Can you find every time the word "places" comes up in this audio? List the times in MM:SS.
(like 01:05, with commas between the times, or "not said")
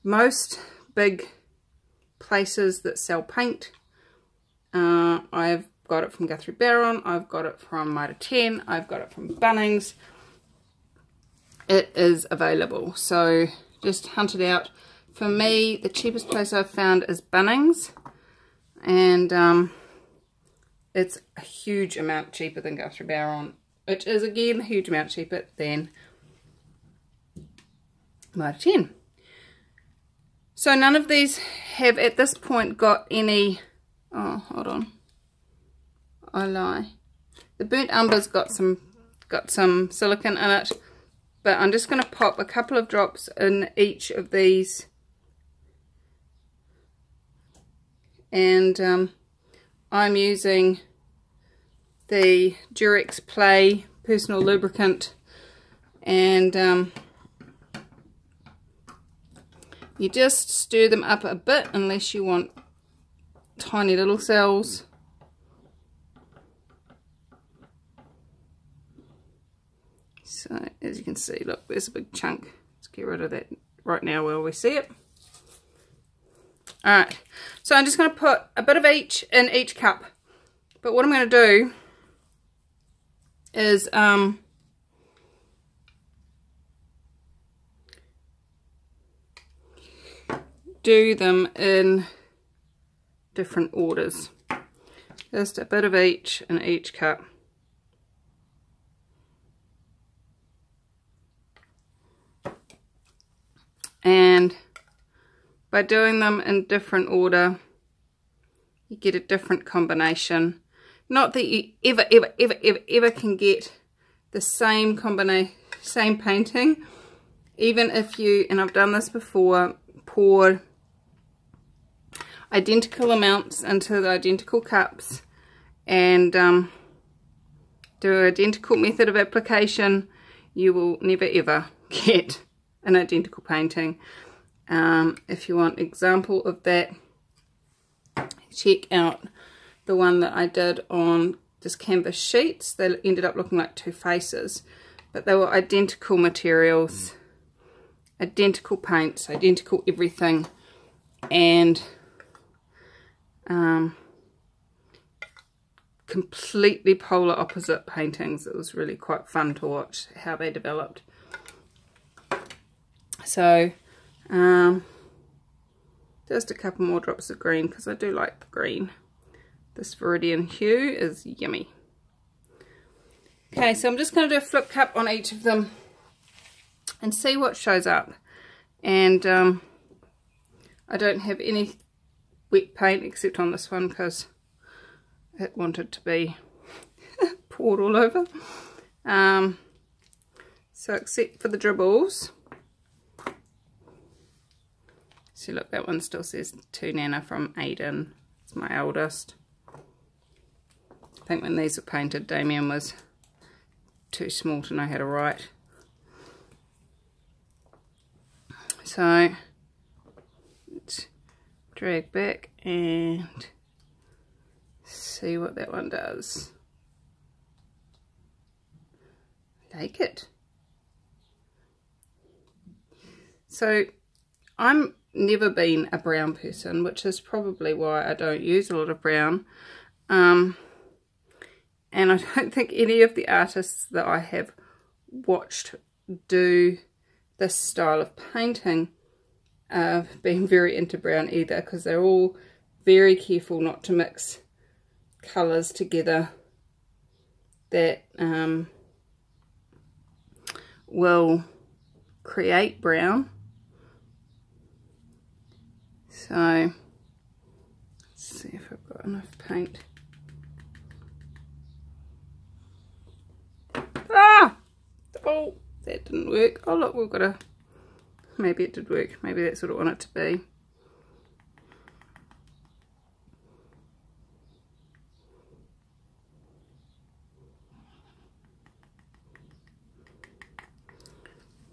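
00:02, 00:16.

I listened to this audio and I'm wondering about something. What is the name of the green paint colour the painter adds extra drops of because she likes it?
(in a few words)
Viridian hue.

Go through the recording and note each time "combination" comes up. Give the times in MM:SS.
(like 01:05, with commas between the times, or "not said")
01:49, 01:54.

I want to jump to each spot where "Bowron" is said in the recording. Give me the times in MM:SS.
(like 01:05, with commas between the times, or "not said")
00:06, 00:23.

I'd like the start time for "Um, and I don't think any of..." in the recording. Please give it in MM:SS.
03:50.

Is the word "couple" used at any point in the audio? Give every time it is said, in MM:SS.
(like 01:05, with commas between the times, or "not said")
00:42, 02:46.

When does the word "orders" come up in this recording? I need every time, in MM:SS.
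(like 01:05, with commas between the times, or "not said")
01:33, 01:47.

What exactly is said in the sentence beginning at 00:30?
So none of these have at this point got any, oh hold on, I lie.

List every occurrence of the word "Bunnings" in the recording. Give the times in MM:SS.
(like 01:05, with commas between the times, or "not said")
00:09, 00:17.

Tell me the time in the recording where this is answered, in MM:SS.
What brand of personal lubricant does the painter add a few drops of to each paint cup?
00:52.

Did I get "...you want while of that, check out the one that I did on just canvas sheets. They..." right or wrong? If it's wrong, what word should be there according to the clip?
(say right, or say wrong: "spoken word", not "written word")
wrong: "example", not "while".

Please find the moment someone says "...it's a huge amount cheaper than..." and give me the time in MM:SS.
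00:20.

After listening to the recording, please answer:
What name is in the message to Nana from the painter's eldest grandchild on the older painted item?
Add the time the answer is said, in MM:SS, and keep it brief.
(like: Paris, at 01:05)
Aiden, at 03:17.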